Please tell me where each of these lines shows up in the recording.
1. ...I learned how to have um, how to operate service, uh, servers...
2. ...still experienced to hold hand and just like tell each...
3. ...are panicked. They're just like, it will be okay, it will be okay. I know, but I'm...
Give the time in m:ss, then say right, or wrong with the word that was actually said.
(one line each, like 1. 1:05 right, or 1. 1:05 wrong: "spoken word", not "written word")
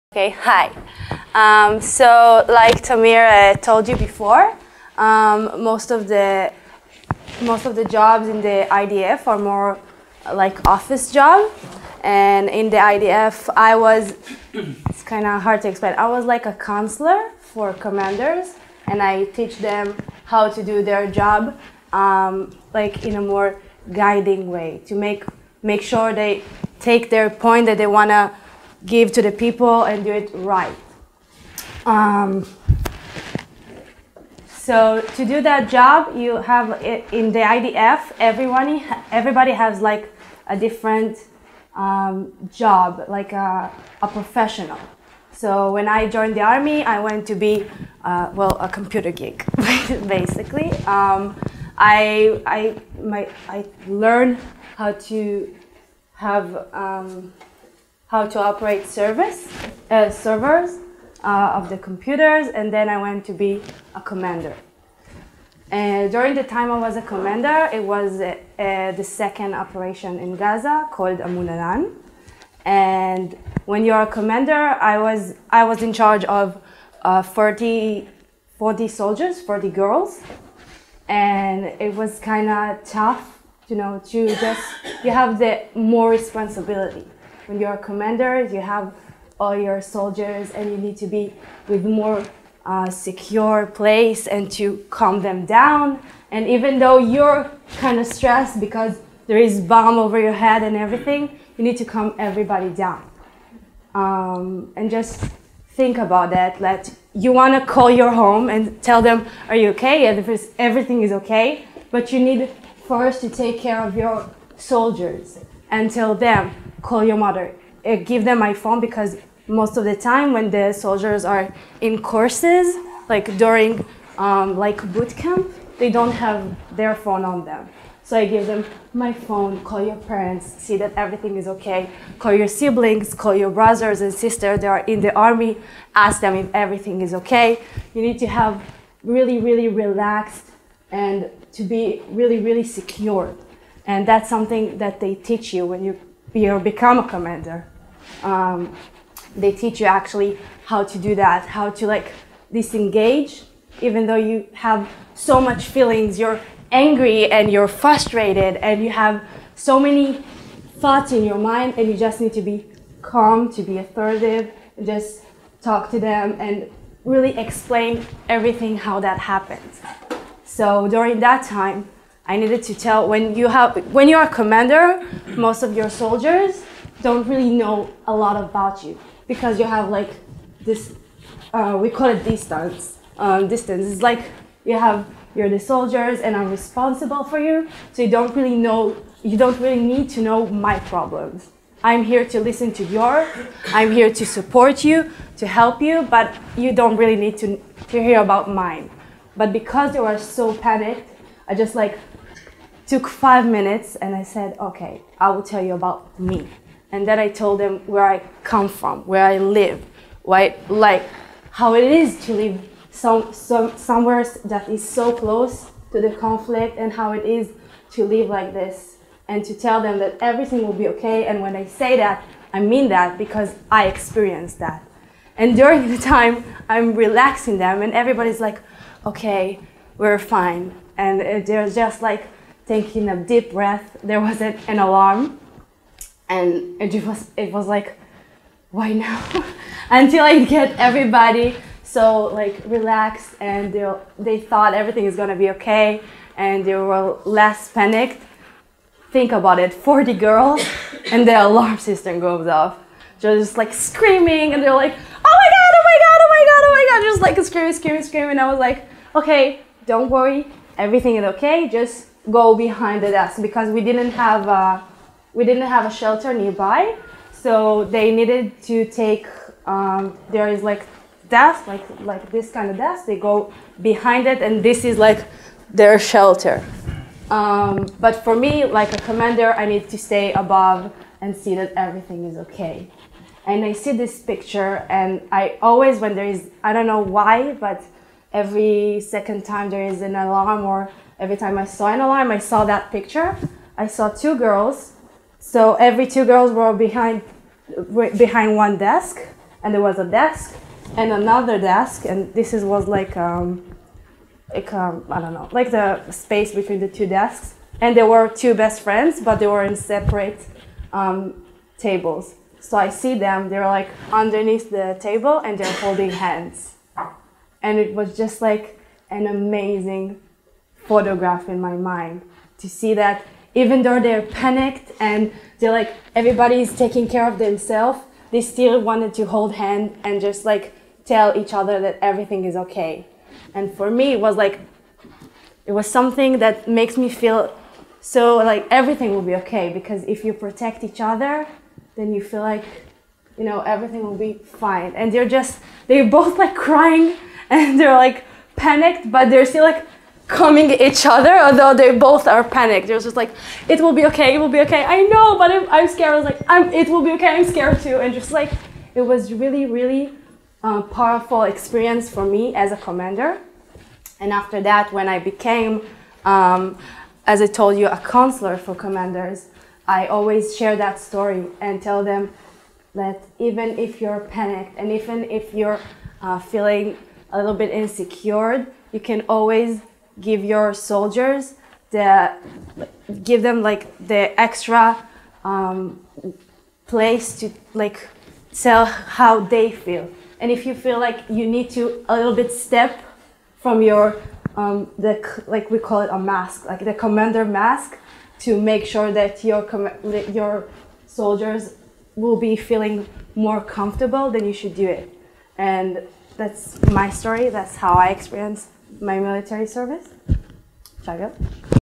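1. 0:53 right
2. 5:28 wrong: "wanted", not "experienced"
3. 5:52 right.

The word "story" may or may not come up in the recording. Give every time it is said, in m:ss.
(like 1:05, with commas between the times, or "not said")
6:10, 6:47.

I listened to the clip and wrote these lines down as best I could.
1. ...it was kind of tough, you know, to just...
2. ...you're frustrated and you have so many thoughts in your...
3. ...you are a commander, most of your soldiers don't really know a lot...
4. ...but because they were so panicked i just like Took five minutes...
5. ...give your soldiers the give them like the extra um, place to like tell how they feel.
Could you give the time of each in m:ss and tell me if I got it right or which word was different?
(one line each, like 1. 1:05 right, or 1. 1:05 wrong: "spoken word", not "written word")
1. 1:21 right
2. 2:37 right
3. 2:54 right
4. 3:19 right
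5. 6:20 right.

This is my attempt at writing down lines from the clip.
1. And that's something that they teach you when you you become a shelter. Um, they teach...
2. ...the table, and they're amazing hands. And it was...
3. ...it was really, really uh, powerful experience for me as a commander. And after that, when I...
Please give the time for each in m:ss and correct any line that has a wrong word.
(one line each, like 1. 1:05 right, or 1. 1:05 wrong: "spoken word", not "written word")
1. 2:23 wrong: "commander", not "shelter"
2. 5:14 wrong: "holding", not "amazing"
3. 5:58 right.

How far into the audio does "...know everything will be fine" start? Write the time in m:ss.
5:43.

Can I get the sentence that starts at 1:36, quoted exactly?
And even though you're kind of stressed because there is bomb over your head and everything, you need to calm everybody down.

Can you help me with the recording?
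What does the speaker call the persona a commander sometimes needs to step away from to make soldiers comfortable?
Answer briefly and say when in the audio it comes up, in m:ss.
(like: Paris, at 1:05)
The commander mask, at 6:36.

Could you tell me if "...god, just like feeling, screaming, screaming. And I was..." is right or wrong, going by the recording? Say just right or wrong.
wrong.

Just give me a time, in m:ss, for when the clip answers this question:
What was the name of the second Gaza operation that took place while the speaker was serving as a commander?
1:11.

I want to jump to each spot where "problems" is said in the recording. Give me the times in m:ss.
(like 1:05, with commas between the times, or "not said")
3:10.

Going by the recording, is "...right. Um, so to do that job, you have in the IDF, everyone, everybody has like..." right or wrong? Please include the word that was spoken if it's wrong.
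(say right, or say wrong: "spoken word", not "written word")
right.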